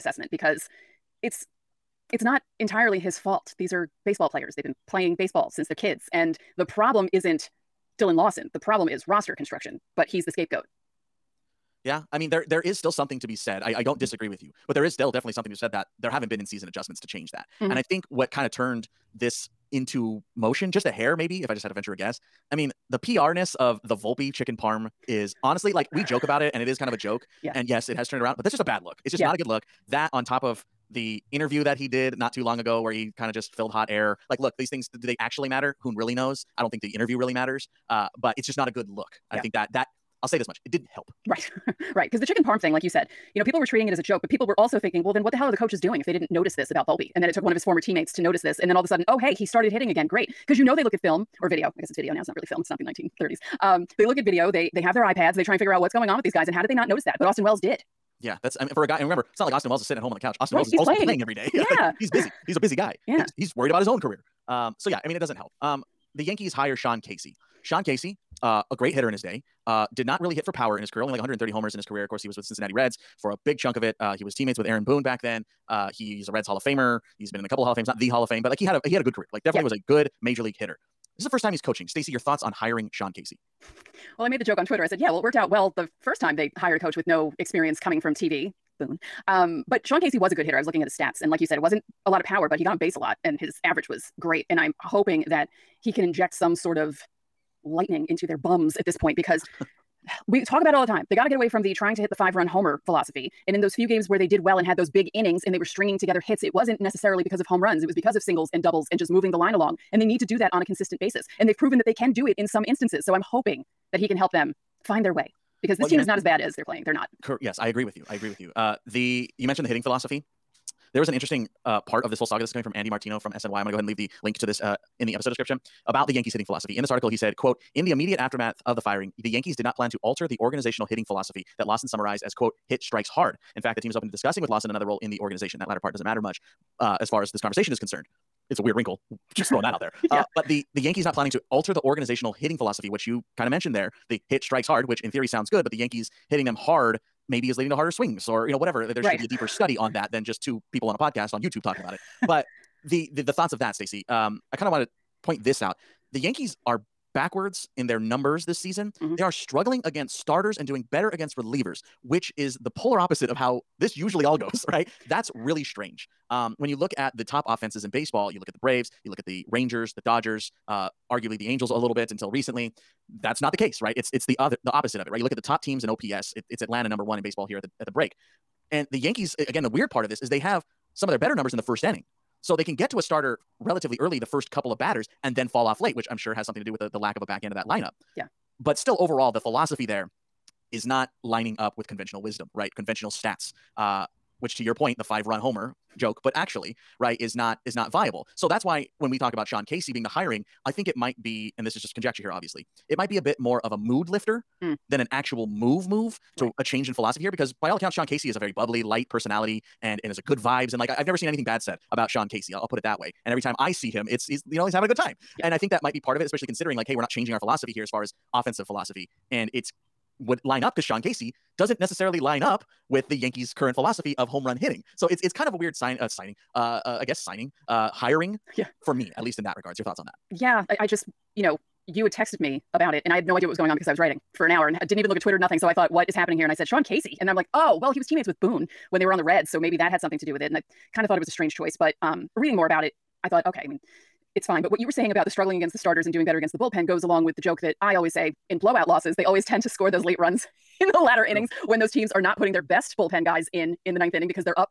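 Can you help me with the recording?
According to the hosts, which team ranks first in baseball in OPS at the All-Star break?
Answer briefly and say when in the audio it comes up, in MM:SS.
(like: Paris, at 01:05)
Atlanta, at 02:56.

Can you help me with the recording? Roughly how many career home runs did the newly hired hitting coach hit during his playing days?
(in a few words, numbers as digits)
130.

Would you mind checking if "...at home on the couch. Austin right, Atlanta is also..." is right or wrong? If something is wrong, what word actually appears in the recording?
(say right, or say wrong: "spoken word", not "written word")
wrong: "Wells", not "Atlanta".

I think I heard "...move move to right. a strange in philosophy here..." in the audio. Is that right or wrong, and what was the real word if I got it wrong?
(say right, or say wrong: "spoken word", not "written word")
wrong: "change", not "strange".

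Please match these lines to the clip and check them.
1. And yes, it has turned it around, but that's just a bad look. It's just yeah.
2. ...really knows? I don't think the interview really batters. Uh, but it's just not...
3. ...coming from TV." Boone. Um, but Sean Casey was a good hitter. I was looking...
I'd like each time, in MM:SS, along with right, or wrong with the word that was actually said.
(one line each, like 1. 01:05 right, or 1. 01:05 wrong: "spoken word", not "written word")
1. 00:27 right
2. 00:35 wrong: "matters", not "batters"
3. 01:27 right.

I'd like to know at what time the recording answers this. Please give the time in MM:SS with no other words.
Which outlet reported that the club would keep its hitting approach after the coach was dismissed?
02:03.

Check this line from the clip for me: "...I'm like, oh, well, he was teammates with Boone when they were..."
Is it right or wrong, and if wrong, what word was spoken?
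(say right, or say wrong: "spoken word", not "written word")
right.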